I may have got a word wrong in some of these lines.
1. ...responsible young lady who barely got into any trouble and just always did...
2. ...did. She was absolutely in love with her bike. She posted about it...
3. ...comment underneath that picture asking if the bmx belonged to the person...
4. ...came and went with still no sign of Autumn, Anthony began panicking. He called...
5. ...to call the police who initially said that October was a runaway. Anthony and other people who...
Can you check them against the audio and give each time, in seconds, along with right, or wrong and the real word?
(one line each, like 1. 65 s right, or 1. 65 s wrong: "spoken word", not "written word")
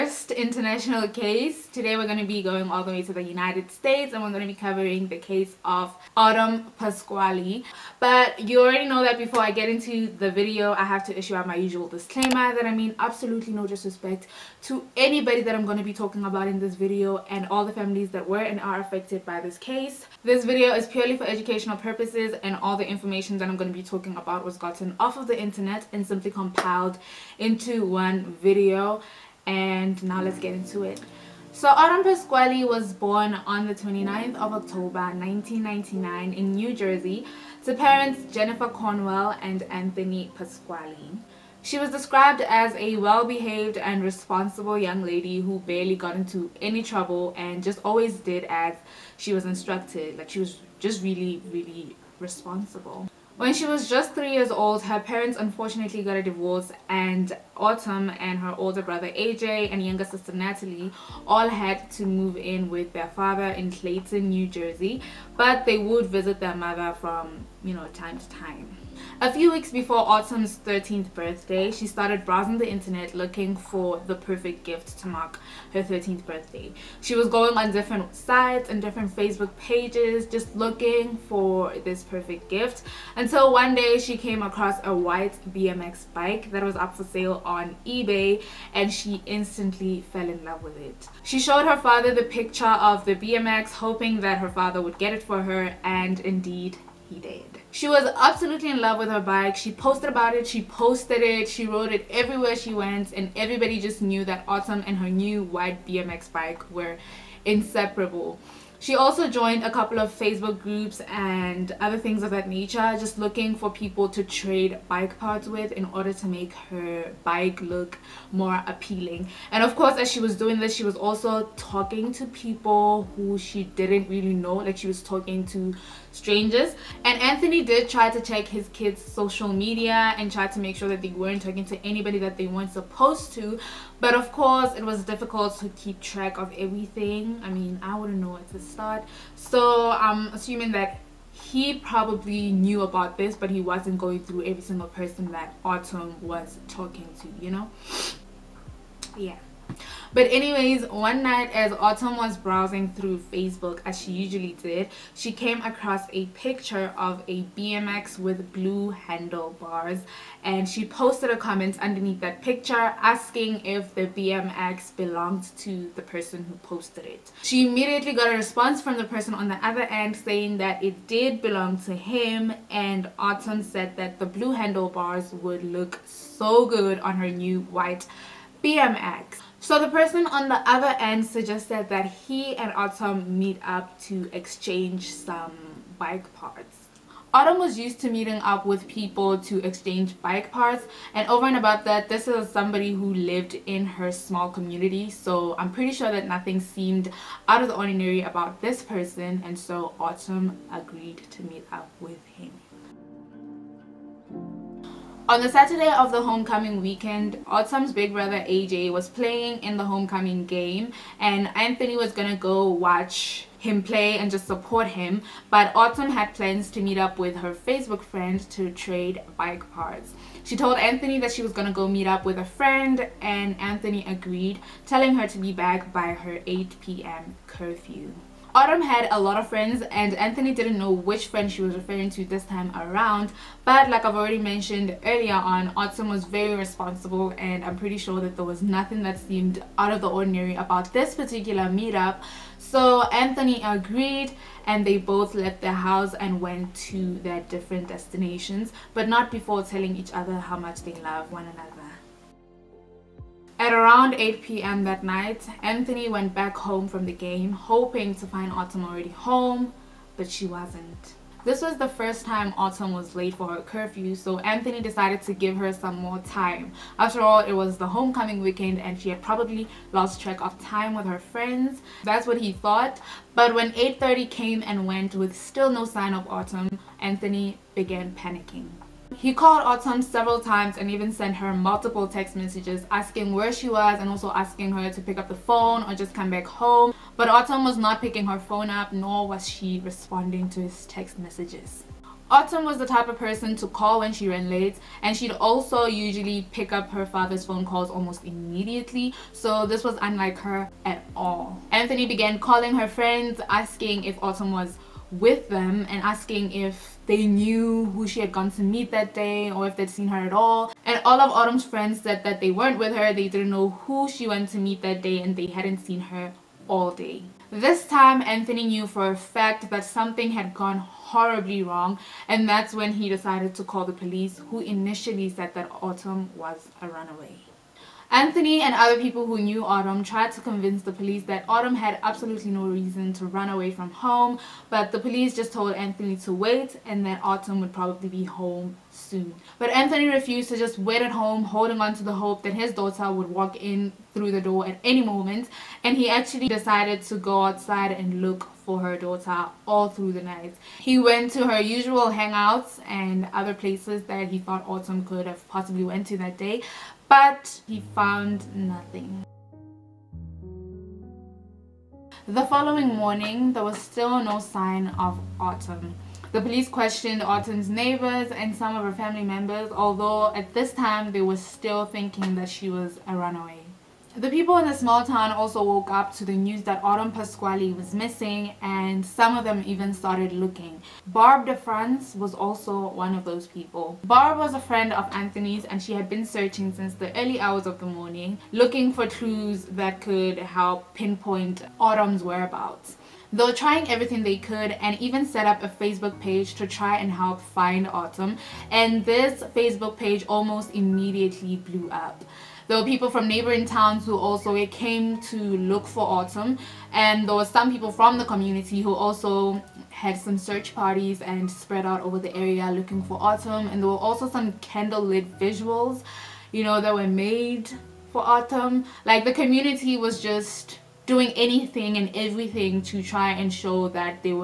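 1. 44 s right
2. 97 s right
3. 161 s right
4. 274 s right
5. 323 s wrong: "Autumn", not "October".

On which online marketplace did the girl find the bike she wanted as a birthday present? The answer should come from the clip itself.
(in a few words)
eBay.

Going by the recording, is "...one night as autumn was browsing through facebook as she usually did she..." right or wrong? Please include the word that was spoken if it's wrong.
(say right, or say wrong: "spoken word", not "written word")
right.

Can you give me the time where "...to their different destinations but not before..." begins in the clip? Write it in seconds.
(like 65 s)
246 s.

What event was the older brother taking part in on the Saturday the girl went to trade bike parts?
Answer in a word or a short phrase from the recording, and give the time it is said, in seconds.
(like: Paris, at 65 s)
Homecoming game, at 209 s.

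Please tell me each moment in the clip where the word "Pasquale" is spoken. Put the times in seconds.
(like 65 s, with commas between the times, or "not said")
6 s, 32 s, 40 s, 377 s.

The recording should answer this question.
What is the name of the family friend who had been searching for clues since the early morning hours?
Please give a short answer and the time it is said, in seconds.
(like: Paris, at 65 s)
Barb de France, at 381 s.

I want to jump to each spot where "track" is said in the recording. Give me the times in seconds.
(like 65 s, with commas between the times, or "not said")
135 s, 270 s.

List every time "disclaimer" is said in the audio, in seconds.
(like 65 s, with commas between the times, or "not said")
11 s.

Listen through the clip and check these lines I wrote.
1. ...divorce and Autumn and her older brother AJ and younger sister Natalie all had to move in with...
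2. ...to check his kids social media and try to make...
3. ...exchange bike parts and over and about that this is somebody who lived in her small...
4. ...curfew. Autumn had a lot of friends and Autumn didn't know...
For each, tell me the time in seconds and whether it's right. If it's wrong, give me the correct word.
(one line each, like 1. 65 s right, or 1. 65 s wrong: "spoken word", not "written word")
1. 56 s right
2. 128 s right
3. 189 s right
4. 227 s wrong: "Anthony", not "Autumn".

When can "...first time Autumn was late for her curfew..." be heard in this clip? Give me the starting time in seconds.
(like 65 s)
261 s.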